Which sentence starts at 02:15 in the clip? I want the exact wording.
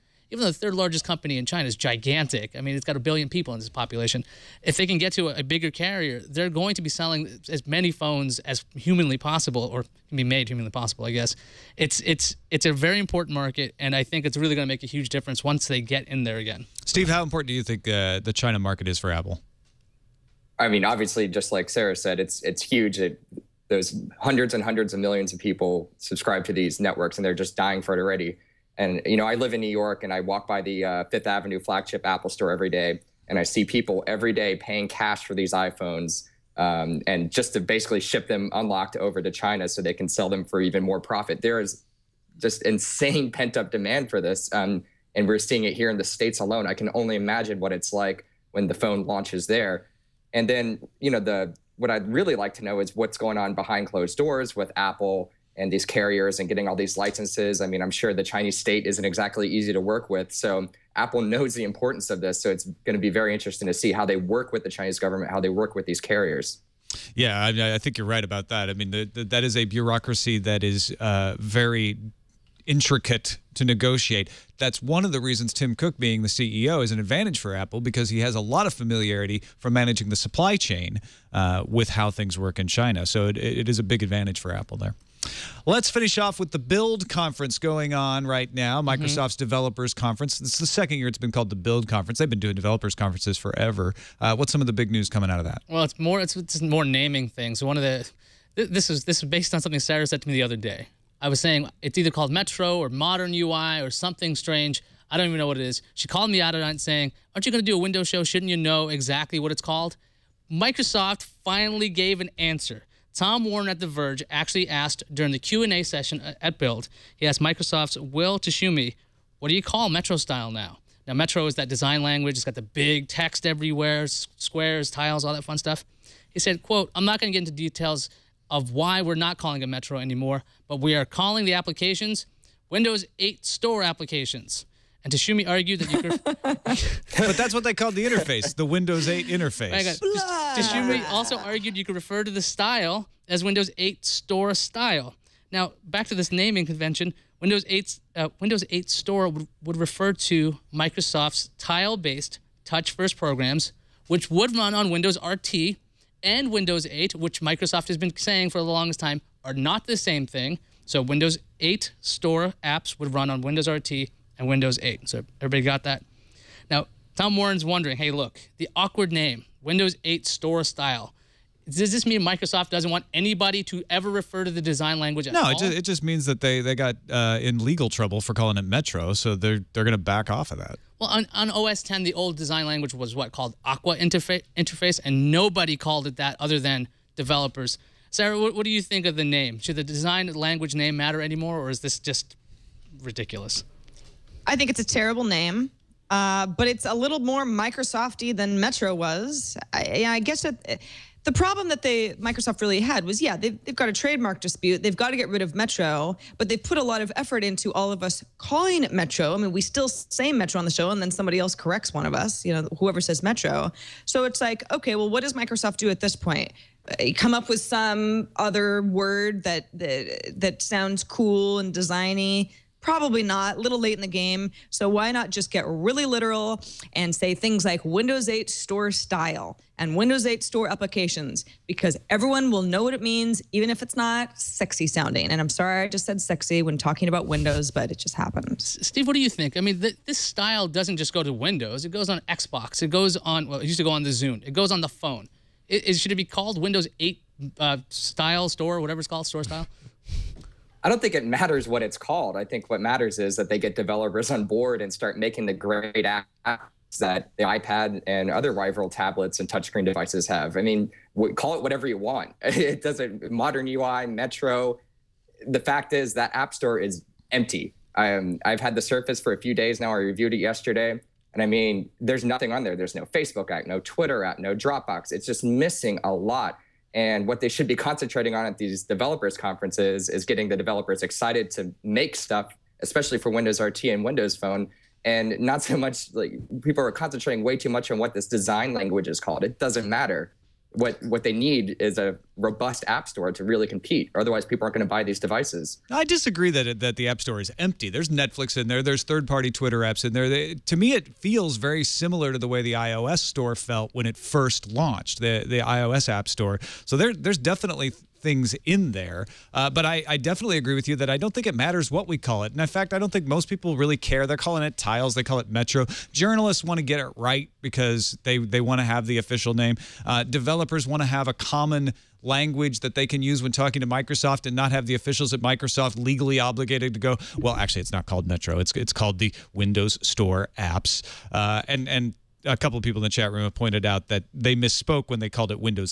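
And Tschumy argued that you could.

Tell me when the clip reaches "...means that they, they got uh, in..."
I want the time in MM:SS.
02:56.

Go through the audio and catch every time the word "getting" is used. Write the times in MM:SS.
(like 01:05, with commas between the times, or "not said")
00:56, 04:40.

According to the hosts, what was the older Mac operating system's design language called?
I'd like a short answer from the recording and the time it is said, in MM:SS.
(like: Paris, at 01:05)
Aqua, at 03:03.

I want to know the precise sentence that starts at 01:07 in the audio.
Yeah, I, mean, I think you're right about that.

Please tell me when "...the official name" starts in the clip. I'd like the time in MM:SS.
05:19.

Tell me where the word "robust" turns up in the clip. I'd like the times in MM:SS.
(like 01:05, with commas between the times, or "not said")
04:52.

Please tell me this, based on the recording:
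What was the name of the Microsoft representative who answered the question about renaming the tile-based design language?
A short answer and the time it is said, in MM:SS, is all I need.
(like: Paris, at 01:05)
Will Tschumy, at 01:57.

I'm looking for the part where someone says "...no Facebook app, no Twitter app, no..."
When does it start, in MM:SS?
04:32.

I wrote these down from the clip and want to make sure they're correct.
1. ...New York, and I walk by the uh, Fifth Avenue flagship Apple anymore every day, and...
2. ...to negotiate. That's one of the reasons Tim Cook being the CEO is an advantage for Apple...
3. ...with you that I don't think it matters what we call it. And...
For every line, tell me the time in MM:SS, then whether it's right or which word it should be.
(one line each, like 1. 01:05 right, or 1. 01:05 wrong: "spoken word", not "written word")
1. 00:29 wrong: "store", not "anymore"
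2. 01:13 right
3. 05:10 right.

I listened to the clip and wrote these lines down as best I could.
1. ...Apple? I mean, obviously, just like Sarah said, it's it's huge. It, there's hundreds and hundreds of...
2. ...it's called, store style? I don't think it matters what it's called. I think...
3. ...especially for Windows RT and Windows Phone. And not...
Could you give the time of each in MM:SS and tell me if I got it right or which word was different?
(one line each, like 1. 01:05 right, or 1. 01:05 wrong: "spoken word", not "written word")
1. 00:19 right
2. 04:08 right
3. 04:42 right.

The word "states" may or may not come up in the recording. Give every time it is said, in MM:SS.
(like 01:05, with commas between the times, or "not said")
00:46, 00:58.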